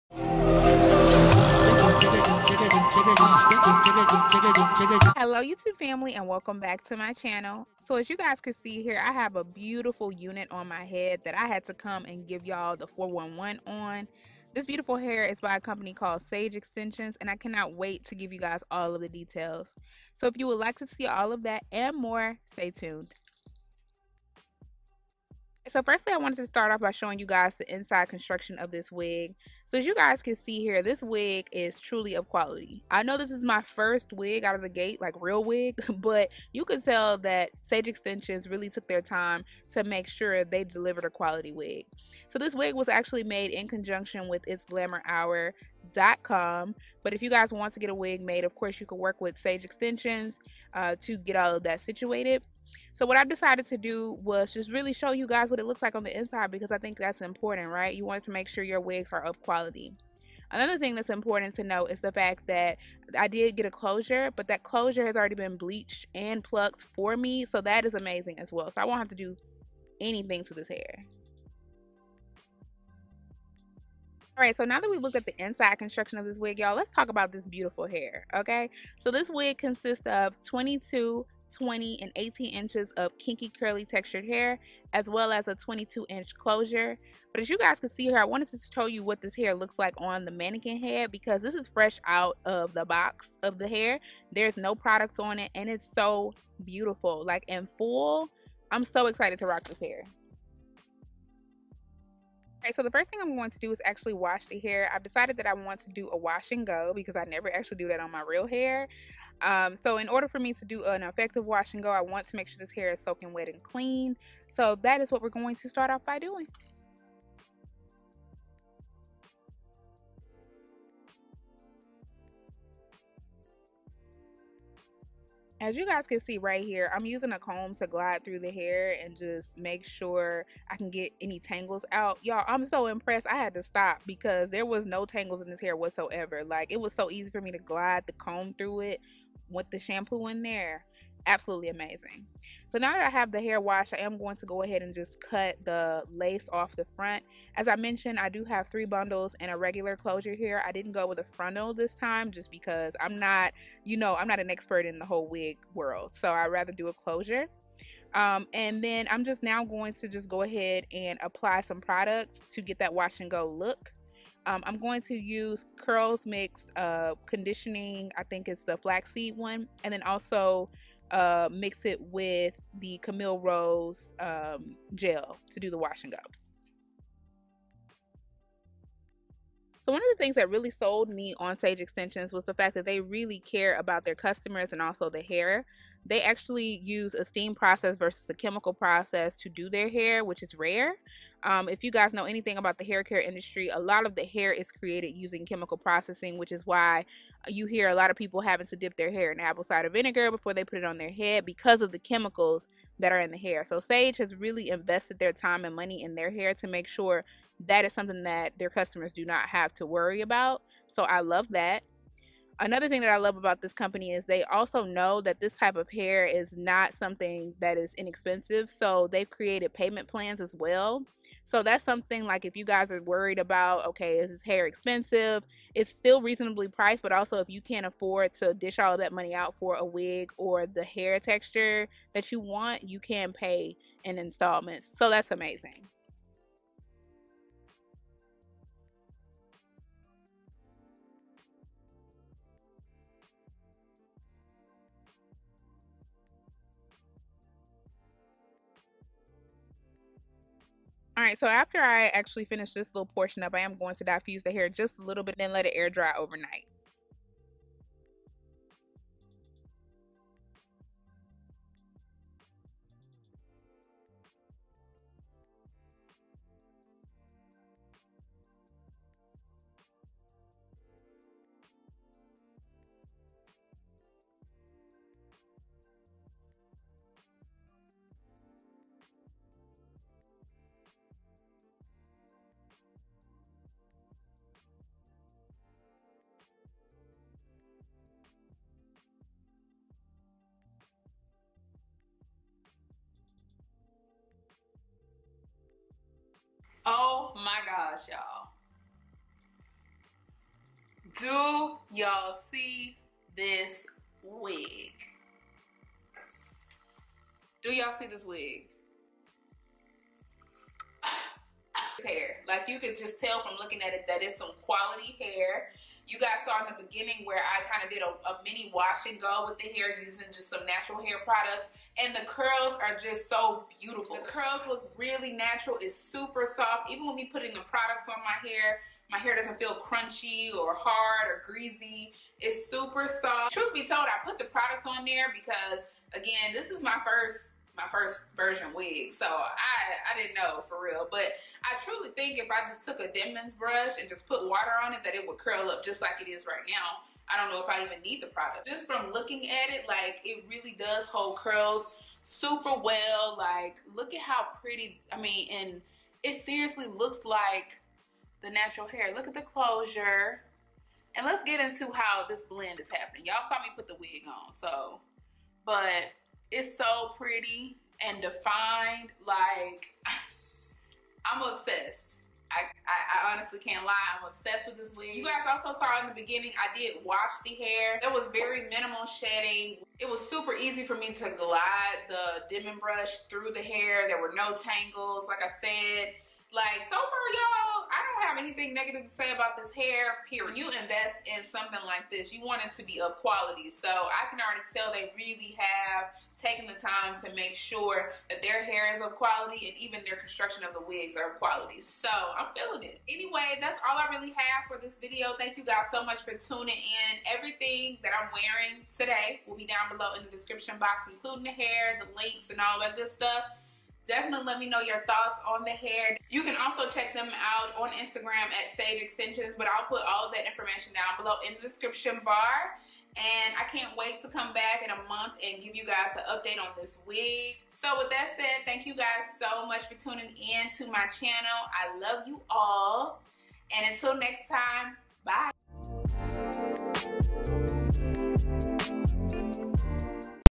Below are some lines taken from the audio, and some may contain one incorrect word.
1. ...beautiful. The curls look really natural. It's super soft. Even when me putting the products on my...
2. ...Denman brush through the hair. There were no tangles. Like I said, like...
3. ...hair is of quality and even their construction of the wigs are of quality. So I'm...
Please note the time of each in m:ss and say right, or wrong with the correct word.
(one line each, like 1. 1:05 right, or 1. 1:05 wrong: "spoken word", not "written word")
1. 5:23 right
2. 6:22 right
3. 6:38 right.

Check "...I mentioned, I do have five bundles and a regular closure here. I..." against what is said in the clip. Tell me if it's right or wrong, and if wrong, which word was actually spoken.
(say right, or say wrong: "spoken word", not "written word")
wrong: "three", not "five".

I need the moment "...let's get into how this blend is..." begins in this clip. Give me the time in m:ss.
6:01.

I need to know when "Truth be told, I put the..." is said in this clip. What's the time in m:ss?
5:33.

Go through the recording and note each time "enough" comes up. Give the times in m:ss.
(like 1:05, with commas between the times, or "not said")
not said.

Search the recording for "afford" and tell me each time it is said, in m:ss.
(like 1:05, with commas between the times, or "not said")
3:47.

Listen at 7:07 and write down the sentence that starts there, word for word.
So with that said, thank you guys so much for tuning in to my channel.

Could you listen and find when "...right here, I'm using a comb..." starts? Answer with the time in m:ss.
2:06.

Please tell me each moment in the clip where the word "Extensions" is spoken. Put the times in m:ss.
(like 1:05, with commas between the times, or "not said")
0:16, 0:37, 0:49, 3:01, 6:59.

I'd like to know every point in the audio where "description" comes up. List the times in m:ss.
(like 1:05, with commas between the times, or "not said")
6:50, 7:01.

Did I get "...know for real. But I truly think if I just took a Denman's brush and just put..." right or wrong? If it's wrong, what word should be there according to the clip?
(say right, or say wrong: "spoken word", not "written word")
right.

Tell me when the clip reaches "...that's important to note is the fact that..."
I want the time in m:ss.
1:00.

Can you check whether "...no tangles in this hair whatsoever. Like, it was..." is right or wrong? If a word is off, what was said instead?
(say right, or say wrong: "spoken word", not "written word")
right.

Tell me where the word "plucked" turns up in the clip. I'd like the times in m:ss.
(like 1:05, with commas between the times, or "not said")
1:06.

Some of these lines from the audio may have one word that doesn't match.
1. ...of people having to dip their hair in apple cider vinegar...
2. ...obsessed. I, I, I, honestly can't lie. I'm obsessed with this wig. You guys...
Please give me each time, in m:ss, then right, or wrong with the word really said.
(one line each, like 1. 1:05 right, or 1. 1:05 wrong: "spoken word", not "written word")
1. 3:18 right
2. 6:11 right.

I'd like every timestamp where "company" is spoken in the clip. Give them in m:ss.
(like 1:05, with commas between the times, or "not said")
0:15, 3:33.